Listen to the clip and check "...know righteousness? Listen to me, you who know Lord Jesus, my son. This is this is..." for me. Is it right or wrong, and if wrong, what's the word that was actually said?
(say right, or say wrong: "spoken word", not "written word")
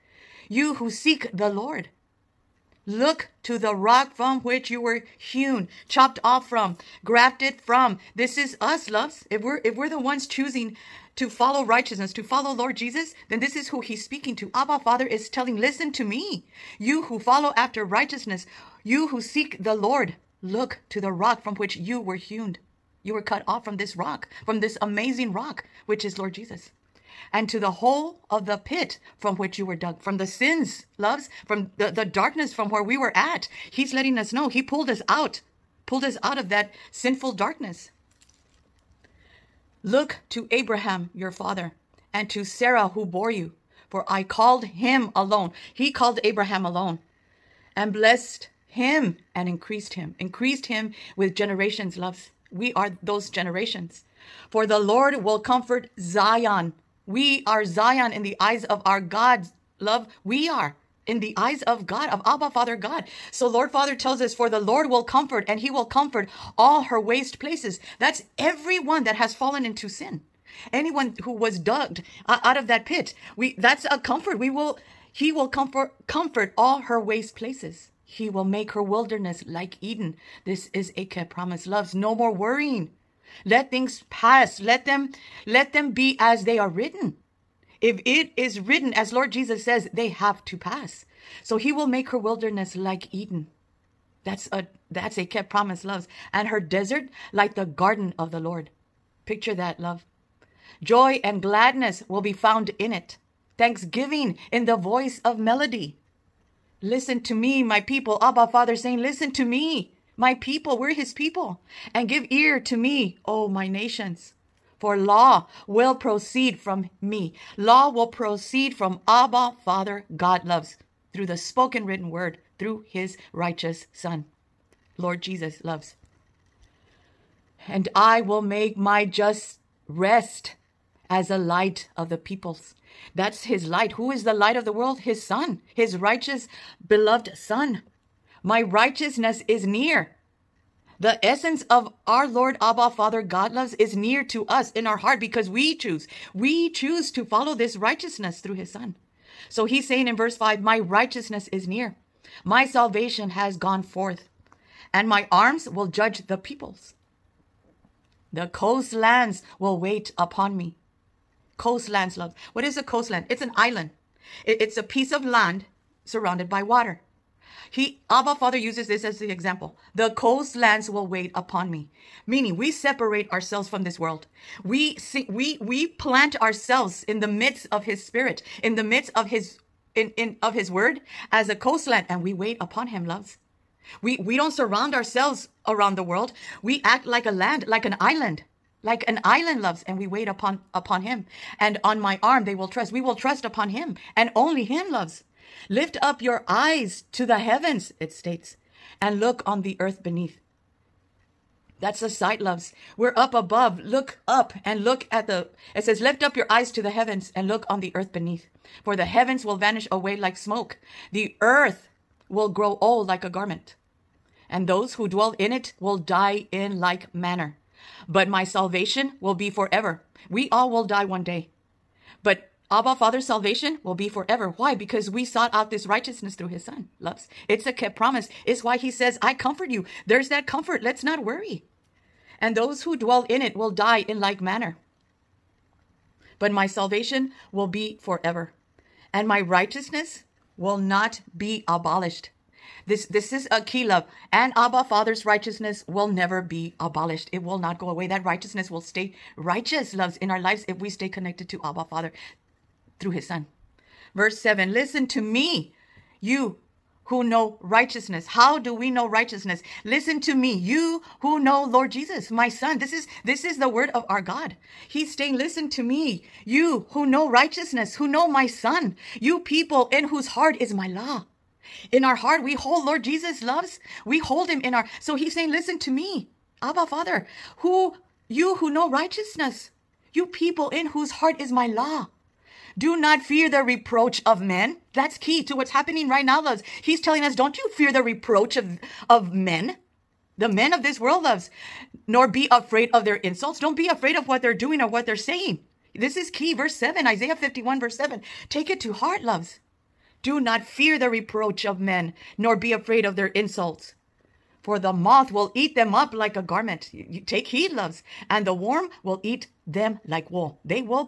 right.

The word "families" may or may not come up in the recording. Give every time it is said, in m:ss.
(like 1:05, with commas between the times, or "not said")
not said.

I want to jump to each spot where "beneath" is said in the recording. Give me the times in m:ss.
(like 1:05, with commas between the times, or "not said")
3:20, 3:28.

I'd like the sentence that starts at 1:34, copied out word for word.
That's a that's a kept promise loves.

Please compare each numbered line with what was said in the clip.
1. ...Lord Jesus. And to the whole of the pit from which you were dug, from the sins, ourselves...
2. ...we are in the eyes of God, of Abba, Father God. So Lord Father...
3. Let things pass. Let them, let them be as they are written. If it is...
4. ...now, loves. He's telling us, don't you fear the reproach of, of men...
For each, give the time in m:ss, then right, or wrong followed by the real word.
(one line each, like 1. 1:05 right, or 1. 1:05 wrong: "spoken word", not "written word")
1. 0:26 wrong: "loves", not "ourselves"
2. 1:00 right
3. 1:23 right
4. 4:46 right.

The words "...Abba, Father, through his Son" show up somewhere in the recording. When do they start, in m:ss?
4:11.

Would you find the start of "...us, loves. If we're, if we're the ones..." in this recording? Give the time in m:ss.
0:08.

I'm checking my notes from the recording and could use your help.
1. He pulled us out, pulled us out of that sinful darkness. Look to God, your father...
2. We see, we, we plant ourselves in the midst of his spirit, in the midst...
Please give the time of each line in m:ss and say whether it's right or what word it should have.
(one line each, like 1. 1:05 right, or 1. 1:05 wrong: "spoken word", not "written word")
1. 0:34 wrong: "Abraham", not "God"
2. 2:54 right.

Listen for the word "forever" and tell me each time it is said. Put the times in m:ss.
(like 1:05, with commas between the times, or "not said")
3:39, 3:44, 3:58.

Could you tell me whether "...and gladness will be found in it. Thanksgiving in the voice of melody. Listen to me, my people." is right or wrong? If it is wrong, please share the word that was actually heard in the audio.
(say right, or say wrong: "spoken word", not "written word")
right.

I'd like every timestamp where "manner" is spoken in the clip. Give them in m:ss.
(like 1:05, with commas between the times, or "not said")
3:37, 3:54.